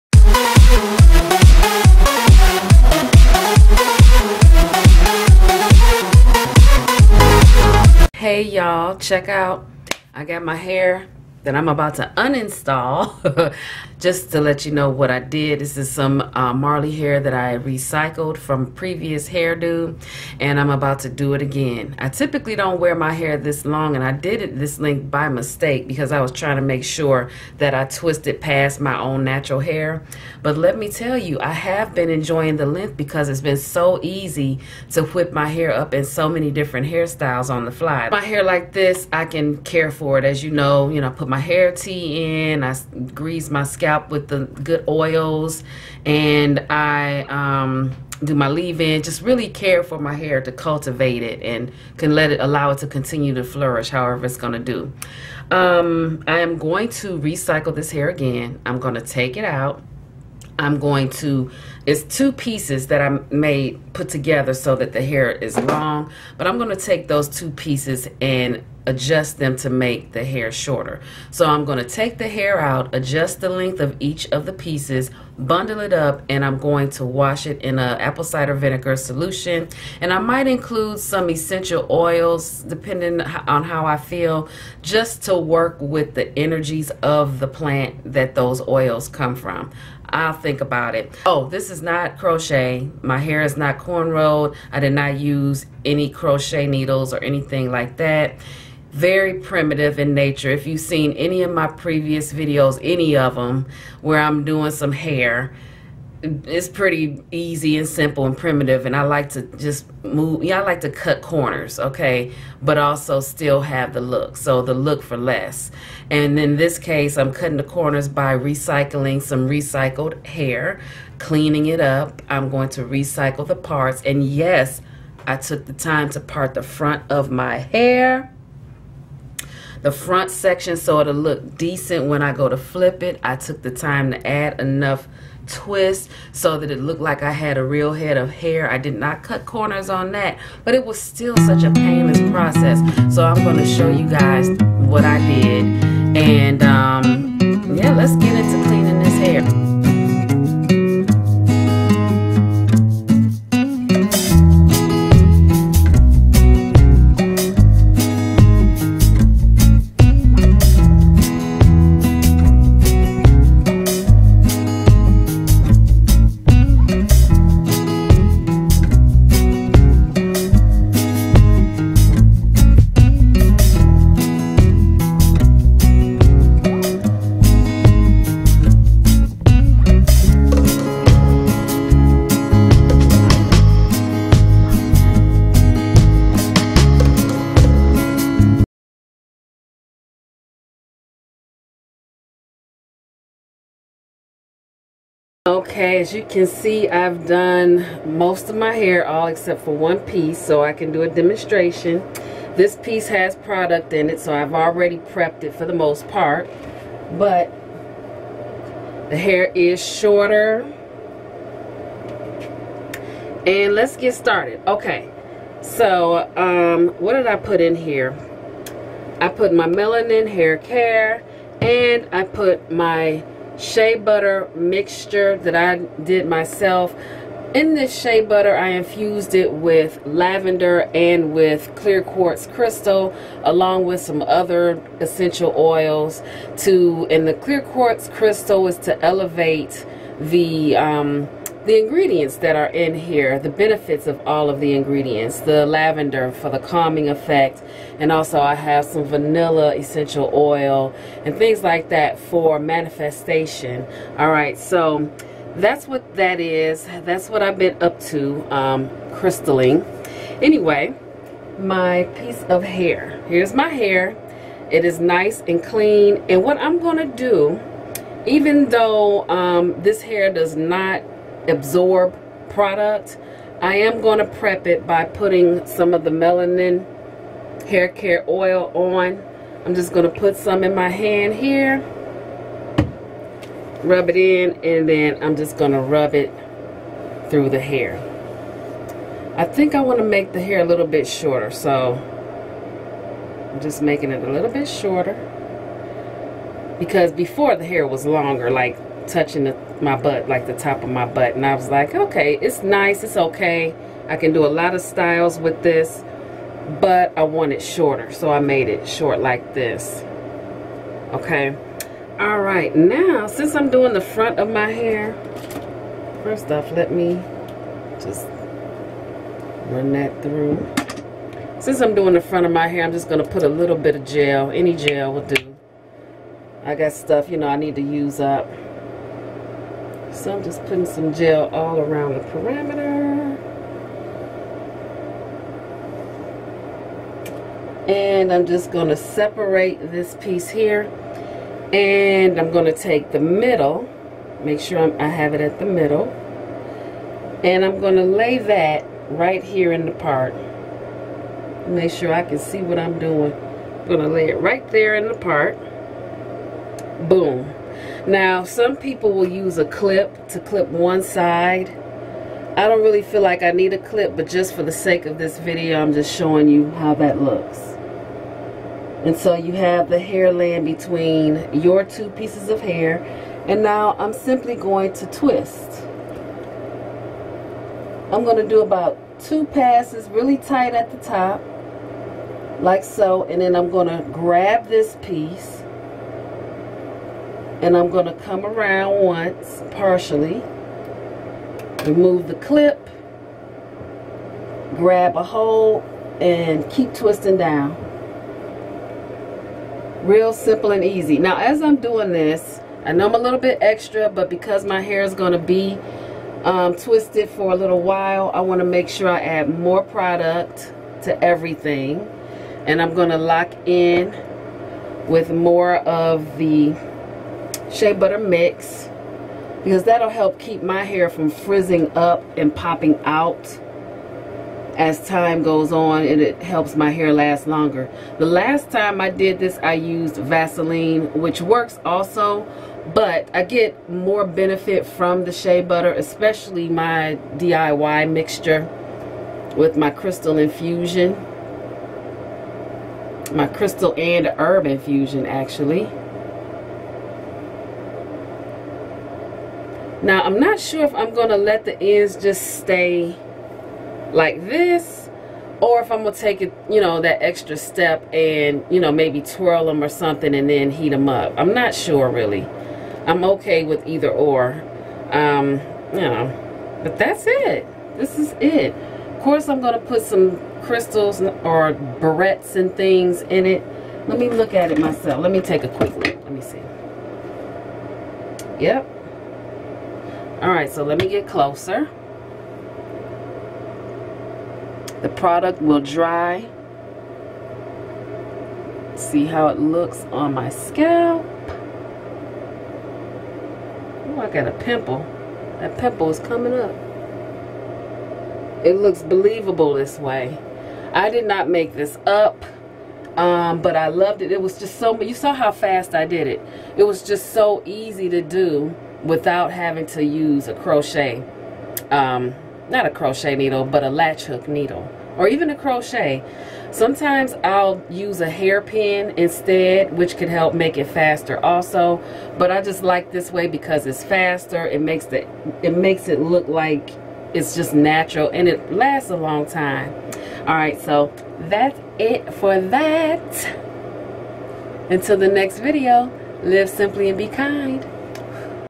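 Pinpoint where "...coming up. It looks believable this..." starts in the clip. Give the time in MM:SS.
08:16.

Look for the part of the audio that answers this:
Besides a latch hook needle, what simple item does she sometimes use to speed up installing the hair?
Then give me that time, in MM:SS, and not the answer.
08:38.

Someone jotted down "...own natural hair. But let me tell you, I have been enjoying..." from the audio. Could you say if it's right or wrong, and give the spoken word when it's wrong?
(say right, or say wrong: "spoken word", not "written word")
right.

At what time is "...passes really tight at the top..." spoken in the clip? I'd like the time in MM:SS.
06:19.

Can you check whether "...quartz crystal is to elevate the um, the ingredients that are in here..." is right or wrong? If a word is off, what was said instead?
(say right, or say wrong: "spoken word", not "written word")
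right.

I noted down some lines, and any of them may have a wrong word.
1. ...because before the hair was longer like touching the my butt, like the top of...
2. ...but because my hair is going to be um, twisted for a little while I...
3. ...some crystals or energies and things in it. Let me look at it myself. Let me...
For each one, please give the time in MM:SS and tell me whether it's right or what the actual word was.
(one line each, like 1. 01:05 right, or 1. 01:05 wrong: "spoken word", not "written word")
1. 04:56 right
2. 06:44 right
3. 07:50 wrong: "barrettes", not "energies".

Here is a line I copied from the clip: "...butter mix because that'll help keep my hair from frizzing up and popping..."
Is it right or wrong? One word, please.
right.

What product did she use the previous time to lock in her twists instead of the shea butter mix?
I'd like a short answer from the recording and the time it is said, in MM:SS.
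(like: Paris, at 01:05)
Vaseline, at 07:10.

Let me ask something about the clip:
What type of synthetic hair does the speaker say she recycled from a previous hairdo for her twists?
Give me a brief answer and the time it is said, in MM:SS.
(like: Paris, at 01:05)
Marley hair, at 00:16.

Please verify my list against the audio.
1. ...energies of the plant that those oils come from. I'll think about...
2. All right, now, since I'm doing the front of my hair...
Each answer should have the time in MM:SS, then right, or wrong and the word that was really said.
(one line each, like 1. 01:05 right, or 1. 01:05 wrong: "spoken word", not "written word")
1. 01:26 right
2. 05:12 right.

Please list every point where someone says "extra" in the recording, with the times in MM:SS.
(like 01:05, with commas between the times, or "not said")
06:43, 07:37.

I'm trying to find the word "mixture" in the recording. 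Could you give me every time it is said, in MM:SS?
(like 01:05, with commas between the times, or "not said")
03:44, 07:18.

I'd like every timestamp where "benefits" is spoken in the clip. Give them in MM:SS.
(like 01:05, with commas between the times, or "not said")
04:03, 07:14.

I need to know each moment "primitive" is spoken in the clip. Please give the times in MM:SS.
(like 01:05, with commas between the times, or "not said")
01:39, 01:48.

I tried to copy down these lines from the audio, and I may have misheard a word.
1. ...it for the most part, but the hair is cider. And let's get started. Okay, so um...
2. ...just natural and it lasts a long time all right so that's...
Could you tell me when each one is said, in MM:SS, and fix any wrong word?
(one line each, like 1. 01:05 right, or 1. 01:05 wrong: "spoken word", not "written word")
1. 03:25 wrong: "shorter", not "cider"
2. 08:47 right.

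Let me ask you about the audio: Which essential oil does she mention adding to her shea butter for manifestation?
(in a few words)
vanilla.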